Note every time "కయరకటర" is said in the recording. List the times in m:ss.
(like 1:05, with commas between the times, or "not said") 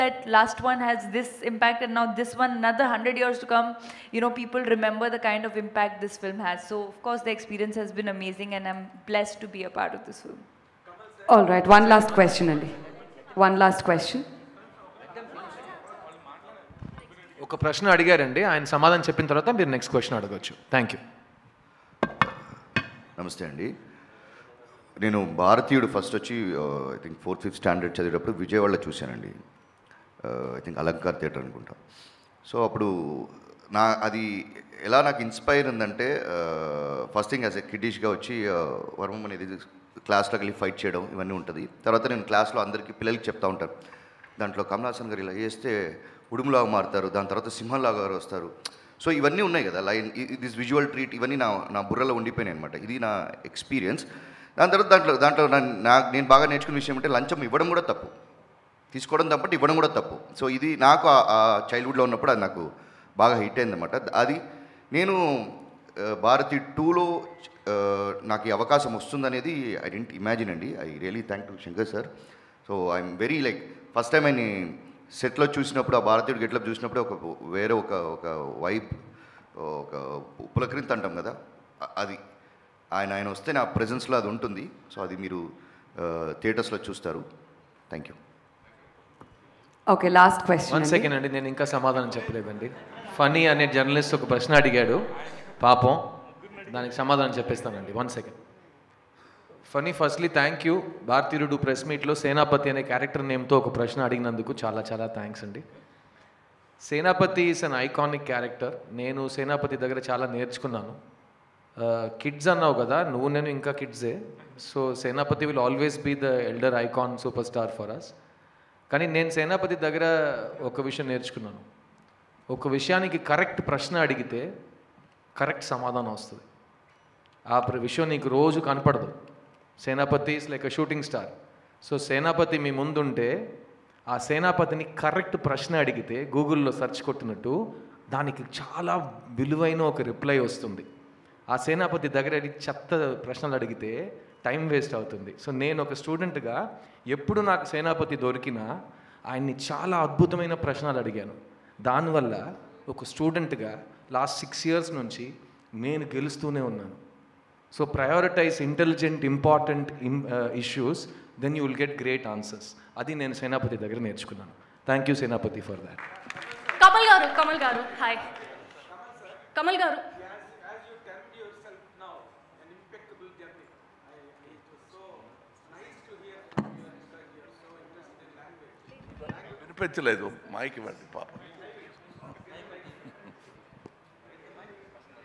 1:42, 1:48.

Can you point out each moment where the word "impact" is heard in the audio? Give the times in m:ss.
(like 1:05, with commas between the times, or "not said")
0:01, 0:05.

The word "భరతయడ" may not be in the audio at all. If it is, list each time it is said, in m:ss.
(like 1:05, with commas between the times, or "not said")
0:25, 1:16, 1:41.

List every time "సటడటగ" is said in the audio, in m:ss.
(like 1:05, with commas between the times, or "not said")
2:26, 2:33.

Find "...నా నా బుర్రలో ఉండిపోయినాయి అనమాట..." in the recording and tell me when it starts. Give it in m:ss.
0:51.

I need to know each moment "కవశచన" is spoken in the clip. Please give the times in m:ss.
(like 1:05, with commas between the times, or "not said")
0:19, 1:30.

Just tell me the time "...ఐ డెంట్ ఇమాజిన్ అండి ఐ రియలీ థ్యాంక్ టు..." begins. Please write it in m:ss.
1:09.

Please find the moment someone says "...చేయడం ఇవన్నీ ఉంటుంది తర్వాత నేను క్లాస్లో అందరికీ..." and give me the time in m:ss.
0:40.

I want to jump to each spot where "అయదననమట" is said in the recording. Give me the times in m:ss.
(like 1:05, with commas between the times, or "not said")
1:03.